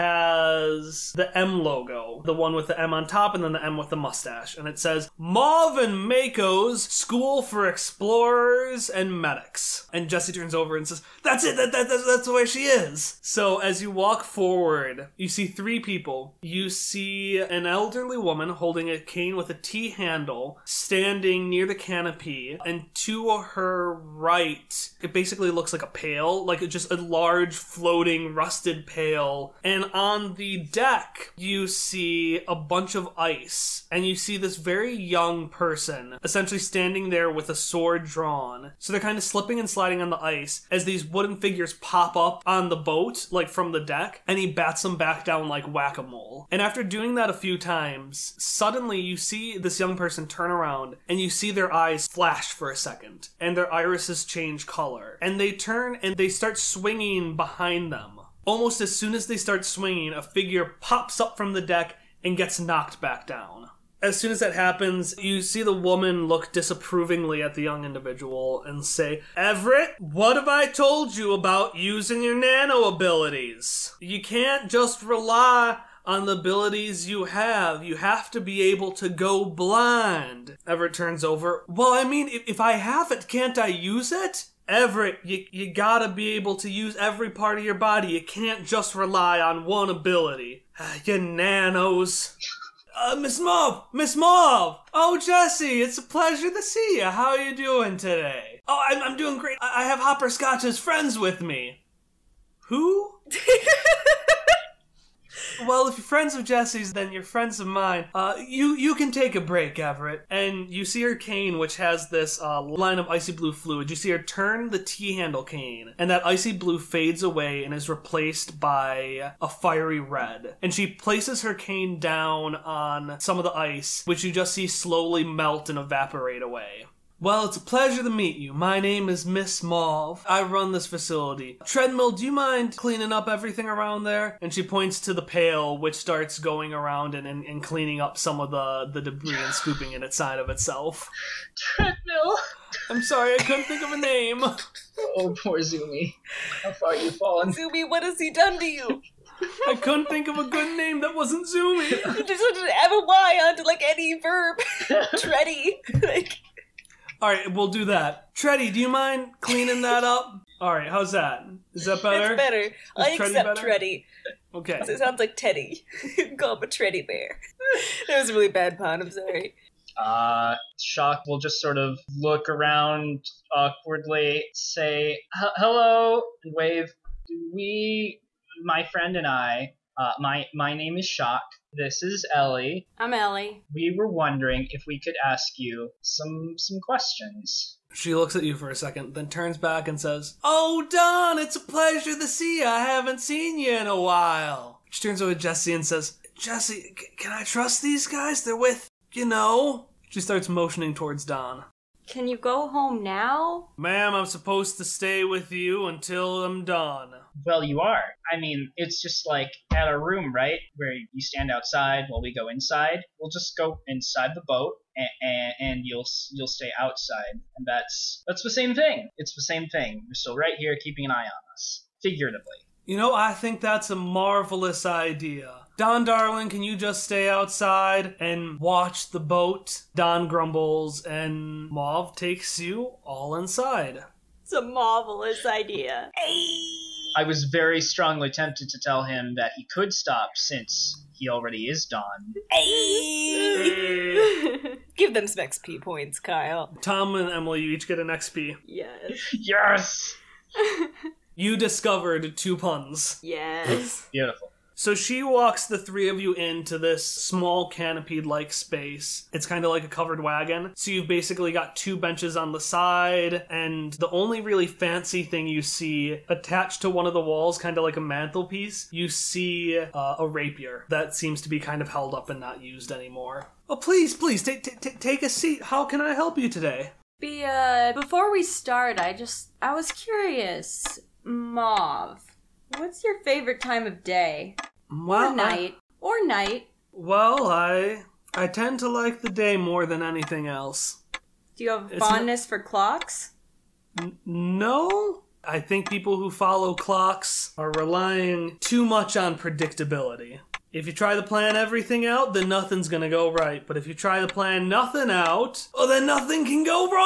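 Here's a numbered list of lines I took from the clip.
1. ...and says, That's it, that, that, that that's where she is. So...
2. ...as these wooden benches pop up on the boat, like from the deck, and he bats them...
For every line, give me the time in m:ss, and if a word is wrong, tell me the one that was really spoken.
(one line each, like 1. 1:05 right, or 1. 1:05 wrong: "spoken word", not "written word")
1. 0:10 right
2. 0:40 wrong: "figures", not "benches".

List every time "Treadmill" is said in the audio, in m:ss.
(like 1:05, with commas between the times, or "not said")
2:11, 2:21.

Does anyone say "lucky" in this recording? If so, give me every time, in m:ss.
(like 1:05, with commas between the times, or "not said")
not said.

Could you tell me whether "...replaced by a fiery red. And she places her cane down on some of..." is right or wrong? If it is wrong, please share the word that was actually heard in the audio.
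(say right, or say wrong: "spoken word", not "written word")
right.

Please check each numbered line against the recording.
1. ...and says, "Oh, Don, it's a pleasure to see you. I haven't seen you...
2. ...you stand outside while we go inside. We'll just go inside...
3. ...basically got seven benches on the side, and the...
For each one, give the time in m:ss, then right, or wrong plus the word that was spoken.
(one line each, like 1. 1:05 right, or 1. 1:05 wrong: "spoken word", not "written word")
1. 3:09 right
2. 3:30 right
3. 4:21 wrong: "two", not "seven".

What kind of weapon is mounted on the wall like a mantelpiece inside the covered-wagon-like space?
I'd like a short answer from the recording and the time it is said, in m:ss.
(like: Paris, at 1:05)
A rapier, at 4:30.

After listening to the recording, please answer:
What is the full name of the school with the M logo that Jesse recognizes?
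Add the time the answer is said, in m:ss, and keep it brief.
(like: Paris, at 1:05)
Marvin Mako's School for Explorers and Medics, at 0:05.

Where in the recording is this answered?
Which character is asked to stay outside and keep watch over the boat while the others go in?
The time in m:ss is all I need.
3:45.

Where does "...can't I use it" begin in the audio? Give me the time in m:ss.
1:23.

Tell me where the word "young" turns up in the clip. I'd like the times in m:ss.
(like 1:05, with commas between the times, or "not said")
0:34, 0:49, 1:07.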